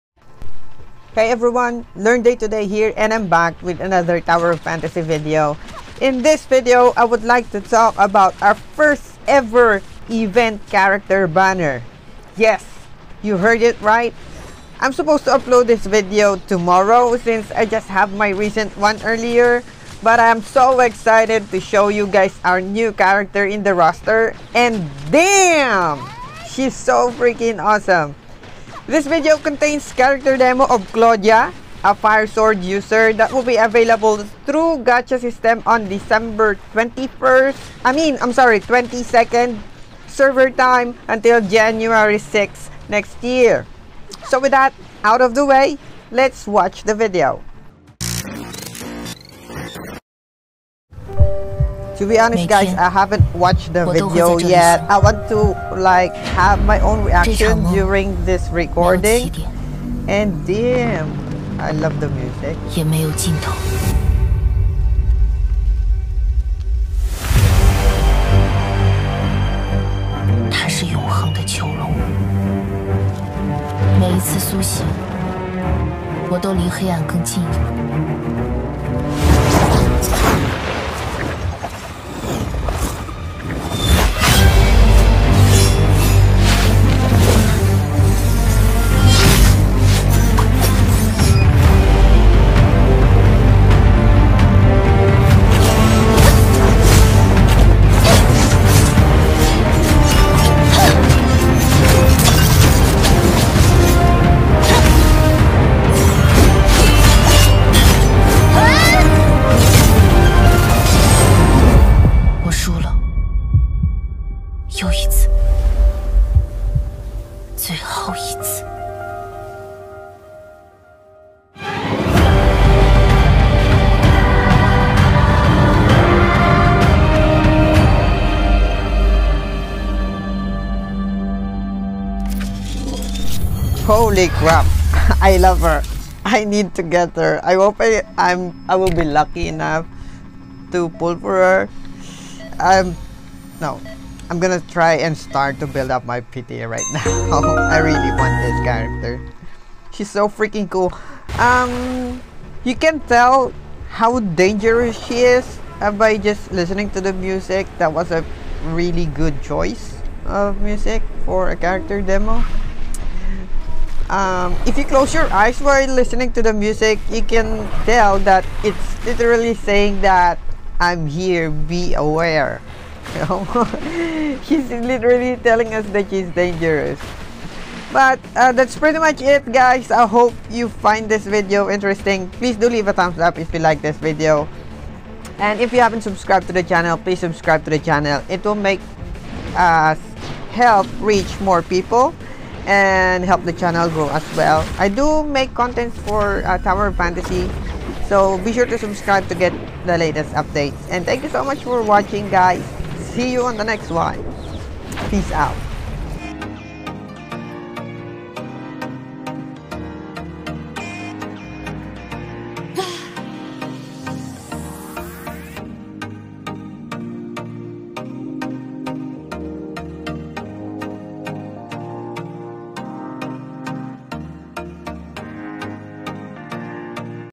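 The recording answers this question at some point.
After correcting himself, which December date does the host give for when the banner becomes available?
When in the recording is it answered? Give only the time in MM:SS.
00:38.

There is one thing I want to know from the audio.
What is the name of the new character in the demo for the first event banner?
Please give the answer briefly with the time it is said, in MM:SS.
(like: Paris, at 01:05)
Claudia, at 00:30.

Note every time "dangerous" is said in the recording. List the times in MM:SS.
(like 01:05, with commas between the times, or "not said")
02:34, 02:56.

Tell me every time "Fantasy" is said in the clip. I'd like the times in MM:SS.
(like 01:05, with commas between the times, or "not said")
00:04, 03:16.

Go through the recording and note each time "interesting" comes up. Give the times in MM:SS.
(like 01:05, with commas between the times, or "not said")
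03:01.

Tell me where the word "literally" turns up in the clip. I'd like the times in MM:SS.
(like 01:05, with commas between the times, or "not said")
02:49, 02:54.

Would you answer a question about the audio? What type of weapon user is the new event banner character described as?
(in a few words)
fire sword.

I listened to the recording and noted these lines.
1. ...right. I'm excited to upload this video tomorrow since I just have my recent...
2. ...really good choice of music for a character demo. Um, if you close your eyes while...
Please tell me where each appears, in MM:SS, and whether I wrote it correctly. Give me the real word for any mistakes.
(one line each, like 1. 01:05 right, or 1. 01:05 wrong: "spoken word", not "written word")
1. 00:13 wrong: "supposed", not "excited"
2. 02:38 right.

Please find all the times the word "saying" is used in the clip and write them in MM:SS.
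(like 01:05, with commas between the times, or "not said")
02:49.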